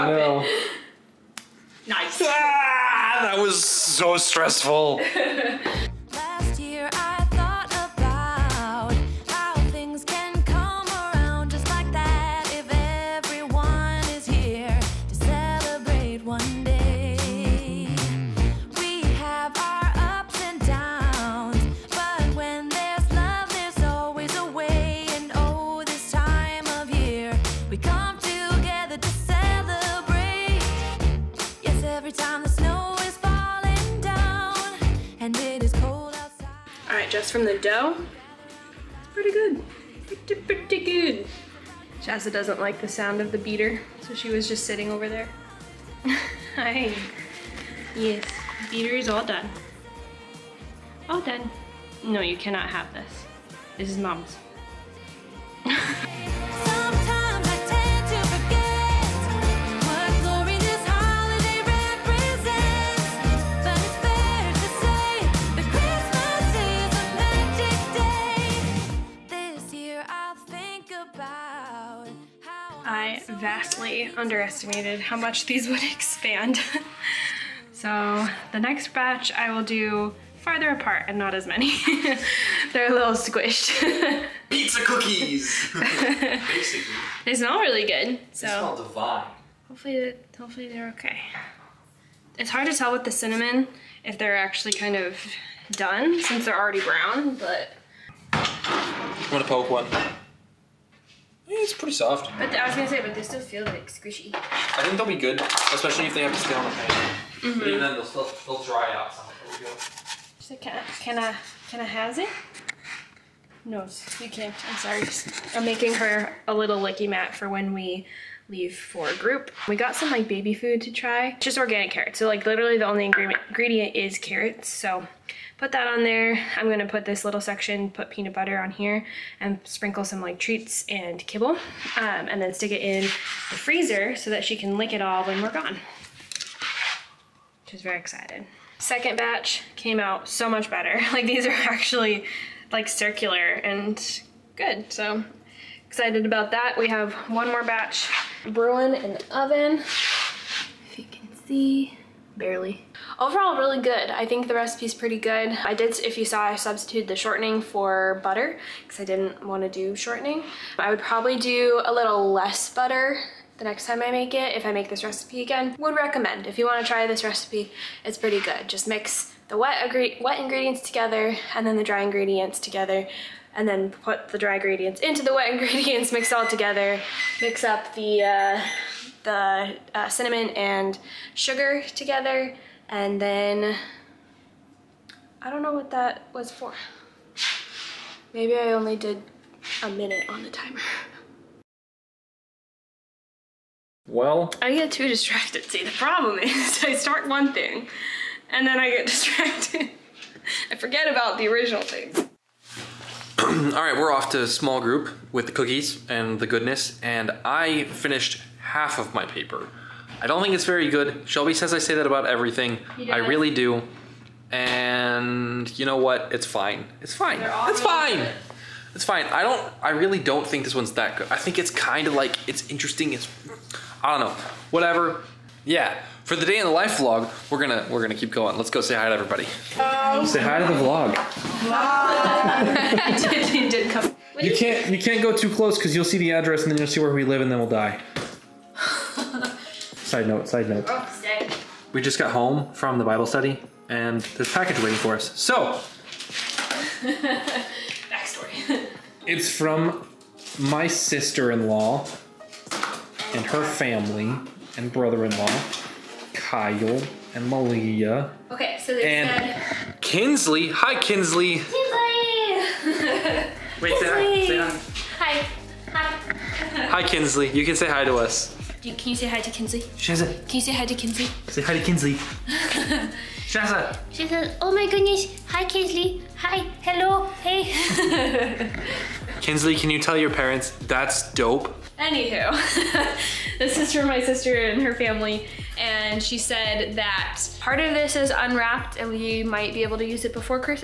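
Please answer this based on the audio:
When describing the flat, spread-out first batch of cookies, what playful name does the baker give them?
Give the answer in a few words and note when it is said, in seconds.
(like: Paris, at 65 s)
Pizza cookies, at 84 s.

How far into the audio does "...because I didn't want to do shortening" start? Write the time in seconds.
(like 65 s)
158 s.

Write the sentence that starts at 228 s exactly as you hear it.
Let's go say hi to everybody.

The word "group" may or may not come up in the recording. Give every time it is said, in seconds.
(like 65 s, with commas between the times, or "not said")
119 s, 204 s.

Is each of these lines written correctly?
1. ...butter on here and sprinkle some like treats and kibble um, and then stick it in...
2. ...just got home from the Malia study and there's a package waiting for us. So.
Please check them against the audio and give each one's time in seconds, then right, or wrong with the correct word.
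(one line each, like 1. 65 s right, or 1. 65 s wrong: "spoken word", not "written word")
1. 128 s right
2. 242 s wrong: "Bible", not "Malia".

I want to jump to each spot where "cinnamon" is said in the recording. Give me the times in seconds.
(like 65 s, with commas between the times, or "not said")
93 s, 180 s.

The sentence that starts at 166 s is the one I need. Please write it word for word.
If you wanna try this recipe, it's pretty good.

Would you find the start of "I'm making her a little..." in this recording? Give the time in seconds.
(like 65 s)
115 s.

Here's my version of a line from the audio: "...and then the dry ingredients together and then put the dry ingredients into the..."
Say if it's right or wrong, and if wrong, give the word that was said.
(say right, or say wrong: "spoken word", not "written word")
right.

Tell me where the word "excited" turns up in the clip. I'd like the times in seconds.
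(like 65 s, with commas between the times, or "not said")
137 s, 145 s.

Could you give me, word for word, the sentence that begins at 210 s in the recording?
I don't think it's very good.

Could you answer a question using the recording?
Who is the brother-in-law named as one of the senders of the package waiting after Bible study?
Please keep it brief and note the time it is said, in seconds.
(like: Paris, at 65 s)
Kyle, at 256 s.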